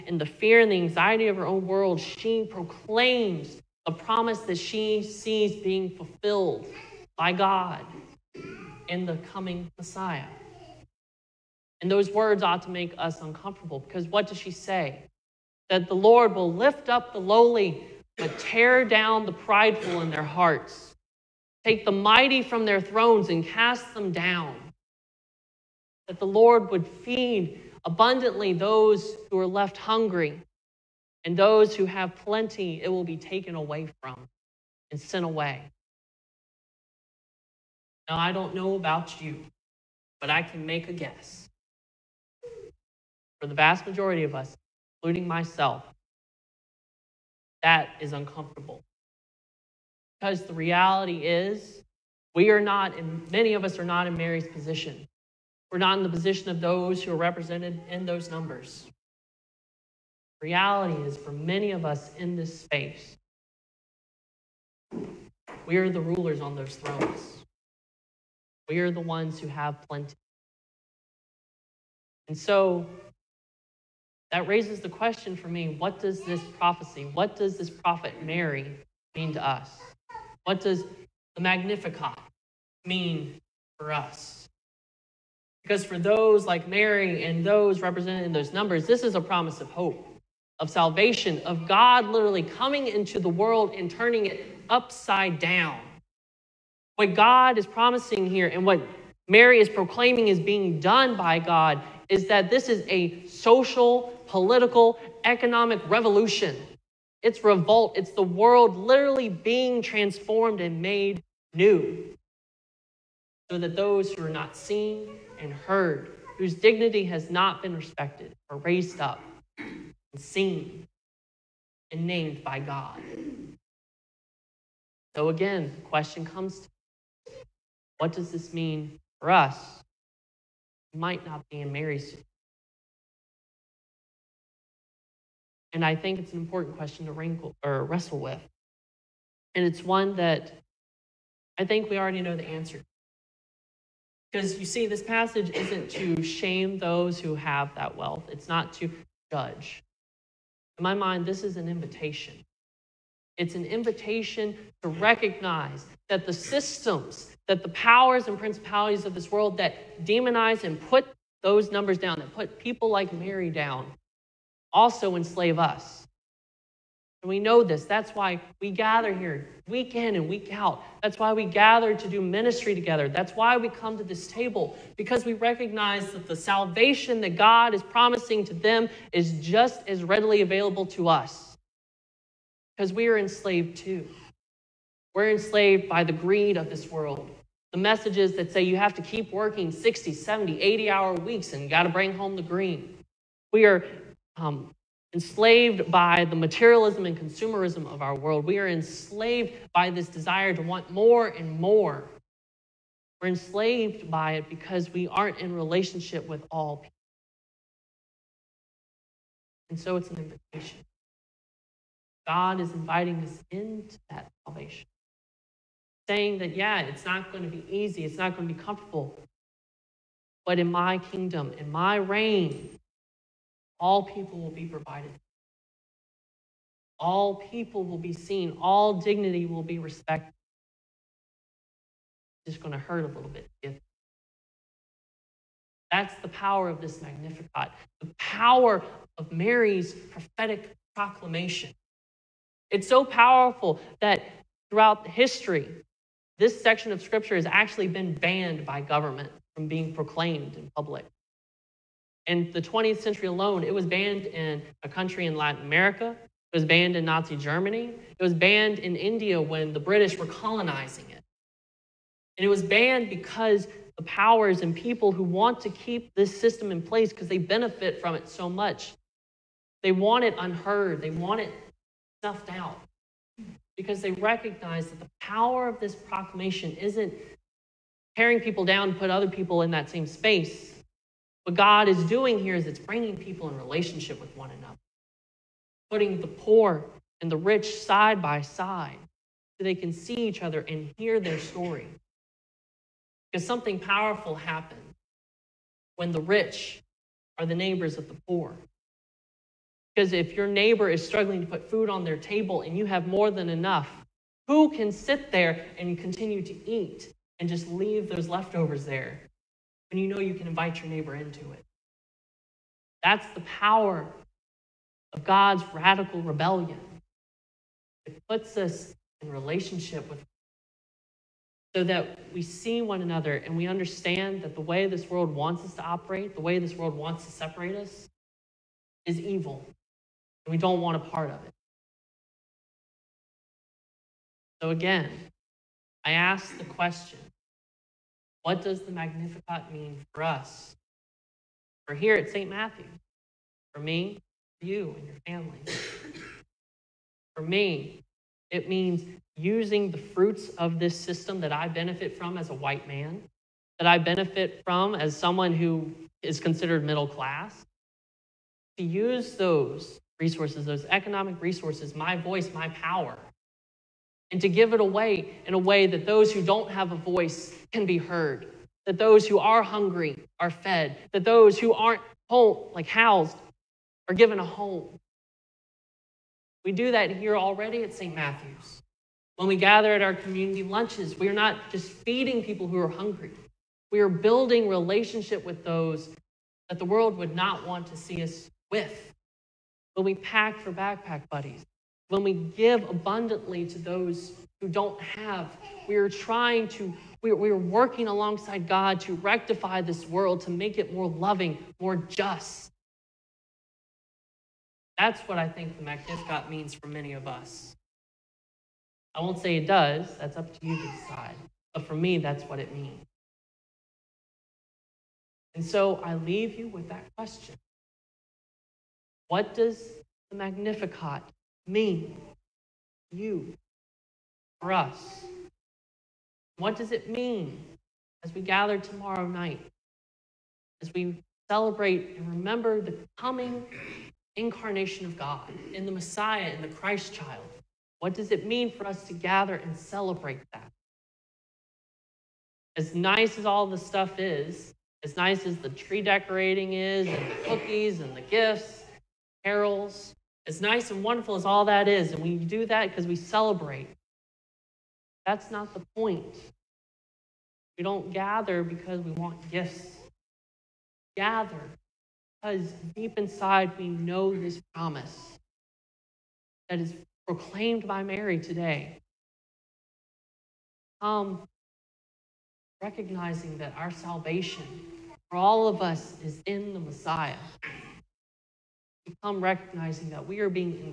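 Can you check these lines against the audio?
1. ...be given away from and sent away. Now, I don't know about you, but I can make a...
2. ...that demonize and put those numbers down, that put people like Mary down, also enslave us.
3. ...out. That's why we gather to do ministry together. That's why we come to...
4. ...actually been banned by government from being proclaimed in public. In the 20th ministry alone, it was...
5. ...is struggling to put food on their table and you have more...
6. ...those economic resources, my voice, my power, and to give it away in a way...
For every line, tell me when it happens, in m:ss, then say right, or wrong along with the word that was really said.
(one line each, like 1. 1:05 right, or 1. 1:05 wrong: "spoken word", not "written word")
1. 0:33 wrong: "taken", not "given"
2. 2:39 right
3. 2:50 right
4. 4:07 wrong: "century", not "ministry"
5. 5:00 right
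6. 6:00 right.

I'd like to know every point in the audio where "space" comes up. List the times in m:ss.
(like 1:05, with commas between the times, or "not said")
1:02, 4:40.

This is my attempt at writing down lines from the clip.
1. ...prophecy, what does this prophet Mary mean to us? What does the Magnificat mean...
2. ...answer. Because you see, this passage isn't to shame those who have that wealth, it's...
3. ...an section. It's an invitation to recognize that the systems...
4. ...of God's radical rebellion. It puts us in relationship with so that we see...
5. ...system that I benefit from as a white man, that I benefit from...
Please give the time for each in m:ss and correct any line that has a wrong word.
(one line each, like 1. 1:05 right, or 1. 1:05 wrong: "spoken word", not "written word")
1. 1:16 right
2. 2:22 right
3. 2:31 wrong: "invitation", not "section"
4. 5:15 right
5. 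5:50 right.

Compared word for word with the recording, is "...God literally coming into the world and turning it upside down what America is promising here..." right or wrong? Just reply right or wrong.
wrong.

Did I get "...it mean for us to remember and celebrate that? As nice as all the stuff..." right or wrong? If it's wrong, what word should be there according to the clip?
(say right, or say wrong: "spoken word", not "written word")
wrong: "gather", not "remember".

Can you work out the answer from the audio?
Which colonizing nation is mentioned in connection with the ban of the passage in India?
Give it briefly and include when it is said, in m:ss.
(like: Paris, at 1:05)
British, at 4:19.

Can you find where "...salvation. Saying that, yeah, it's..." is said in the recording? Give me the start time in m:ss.
3:34.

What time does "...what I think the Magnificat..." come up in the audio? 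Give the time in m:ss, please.
6:45.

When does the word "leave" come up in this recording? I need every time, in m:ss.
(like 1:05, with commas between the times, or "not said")
5:07, 6:56.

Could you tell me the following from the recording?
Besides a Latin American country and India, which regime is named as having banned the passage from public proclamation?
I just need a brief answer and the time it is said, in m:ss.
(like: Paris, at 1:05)
Nazi Germany, at 4:17.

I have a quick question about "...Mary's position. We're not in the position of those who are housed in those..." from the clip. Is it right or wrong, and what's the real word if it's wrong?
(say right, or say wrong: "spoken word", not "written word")
wrong: "represented", not "housed".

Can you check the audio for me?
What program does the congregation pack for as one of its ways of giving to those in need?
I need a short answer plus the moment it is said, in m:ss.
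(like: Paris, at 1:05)
backpack buddies, at 6:30.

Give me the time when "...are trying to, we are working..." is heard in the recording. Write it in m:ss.
6:35.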